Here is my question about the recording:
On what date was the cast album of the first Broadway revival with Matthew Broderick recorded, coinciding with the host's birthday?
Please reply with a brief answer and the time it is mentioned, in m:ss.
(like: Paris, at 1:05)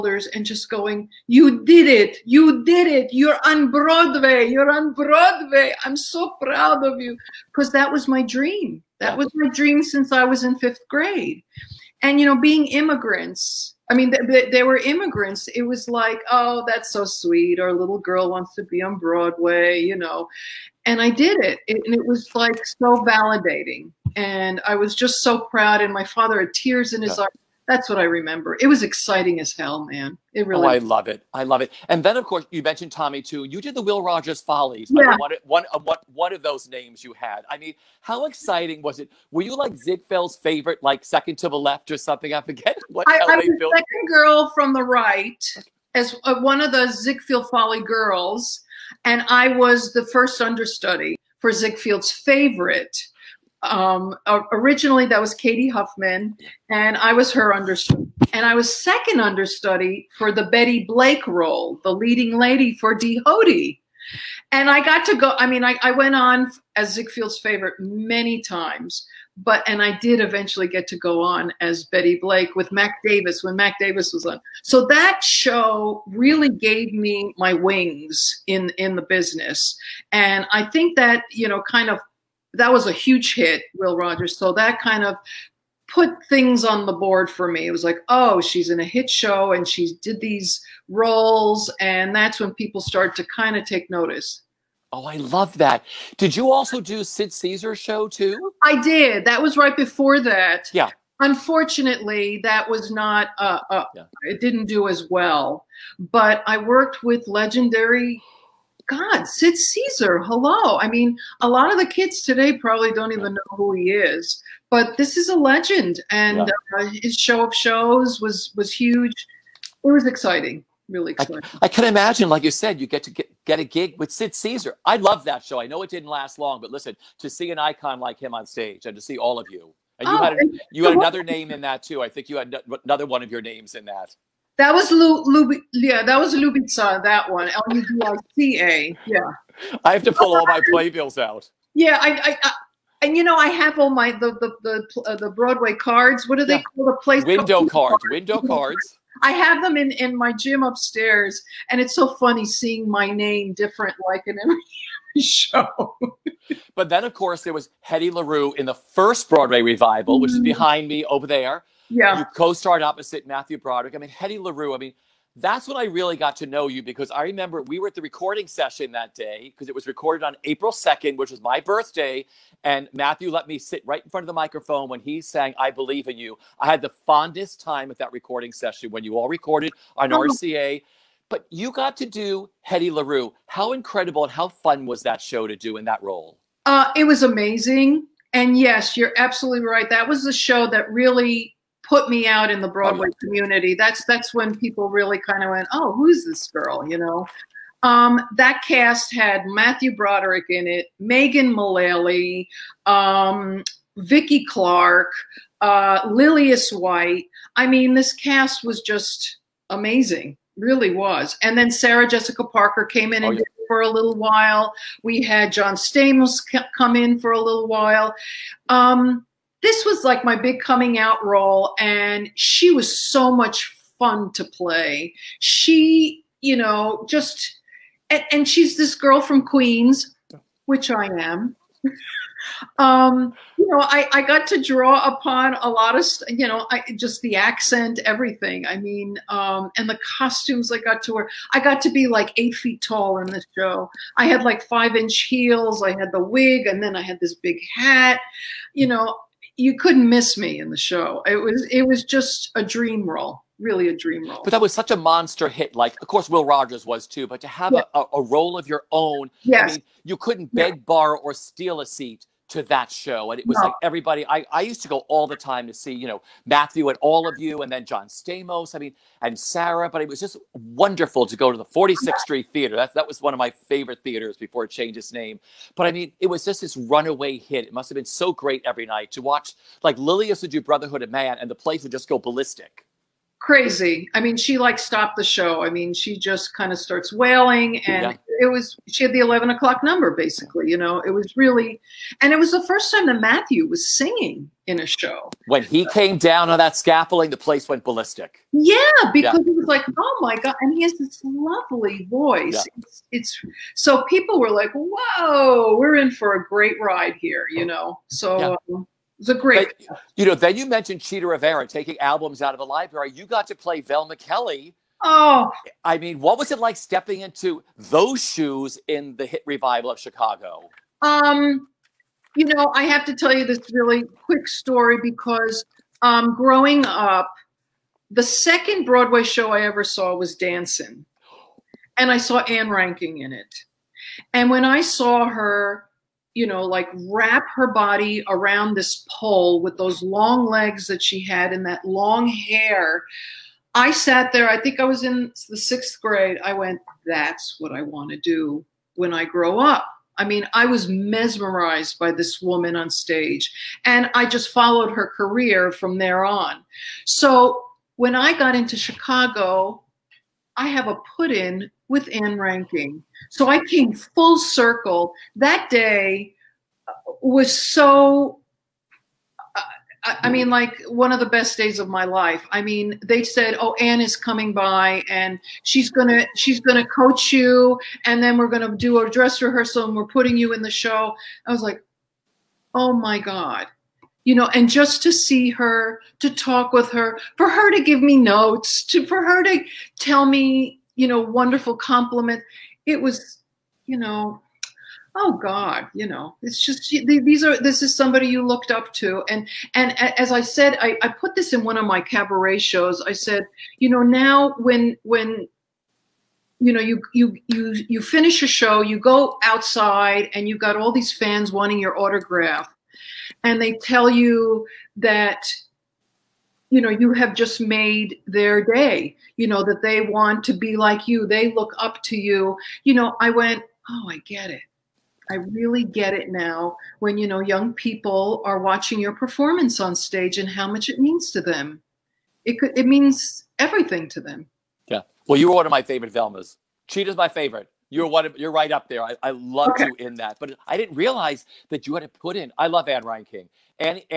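April 2nd, at 2:50.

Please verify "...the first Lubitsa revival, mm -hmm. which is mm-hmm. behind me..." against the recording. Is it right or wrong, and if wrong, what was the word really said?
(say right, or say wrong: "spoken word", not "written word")
wrong: "Broadway", not "Lubitsa".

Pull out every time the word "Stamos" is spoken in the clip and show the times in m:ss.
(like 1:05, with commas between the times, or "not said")
3:35, 4:28.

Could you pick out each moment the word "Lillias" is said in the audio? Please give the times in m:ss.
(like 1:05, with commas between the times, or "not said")
3:26, 4:39.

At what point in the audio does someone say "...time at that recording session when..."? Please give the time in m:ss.
2:57.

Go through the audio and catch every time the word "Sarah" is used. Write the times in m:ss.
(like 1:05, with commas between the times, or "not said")
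3:31, 4:29.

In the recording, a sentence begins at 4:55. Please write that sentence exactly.
When he came down on that scaffolding, the place went ballistic.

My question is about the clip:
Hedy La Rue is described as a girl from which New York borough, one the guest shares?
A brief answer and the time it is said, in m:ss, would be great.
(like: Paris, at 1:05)
Queens, at 3:49.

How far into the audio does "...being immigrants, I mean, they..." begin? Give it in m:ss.
0:12.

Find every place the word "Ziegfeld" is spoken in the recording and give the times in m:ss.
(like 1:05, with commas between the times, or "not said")
0:39, 0:46, 0:51, 1:06.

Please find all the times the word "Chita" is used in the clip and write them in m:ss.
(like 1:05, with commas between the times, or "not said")
5:11, 7:16.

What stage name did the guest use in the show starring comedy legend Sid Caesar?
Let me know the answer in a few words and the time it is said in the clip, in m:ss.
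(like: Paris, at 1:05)
Lubitsa, at 2:16.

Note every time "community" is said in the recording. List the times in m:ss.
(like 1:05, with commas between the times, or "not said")
3:13.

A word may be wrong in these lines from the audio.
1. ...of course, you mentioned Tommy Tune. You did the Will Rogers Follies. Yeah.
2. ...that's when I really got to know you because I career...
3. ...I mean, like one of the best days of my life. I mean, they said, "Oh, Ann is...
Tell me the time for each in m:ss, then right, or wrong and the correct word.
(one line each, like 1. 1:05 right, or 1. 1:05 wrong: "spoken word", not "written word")
1. 0:32 right
2. 2:45 wrong: "remember", not "career"
3. 6:10 right.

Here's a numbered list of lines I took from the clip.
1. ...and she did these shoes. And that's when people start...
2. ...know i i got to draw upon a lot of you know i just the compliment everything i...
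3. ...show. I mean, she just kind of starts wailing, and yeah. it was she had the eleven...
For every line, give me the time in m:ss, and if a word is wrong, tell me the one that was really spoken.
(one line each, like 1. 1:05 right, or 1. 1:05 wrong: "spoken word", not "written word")
1. 1:29 wrong: "roles", not "shoes"
2. 3:53 wrong: "accent", not "compliment"
3. 4:45 right.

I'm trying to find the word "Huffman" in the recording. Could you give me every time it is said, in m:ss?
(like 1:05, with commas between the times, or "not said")
0:55.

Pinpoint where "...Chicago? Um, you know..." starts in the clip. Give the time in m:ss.
5:19.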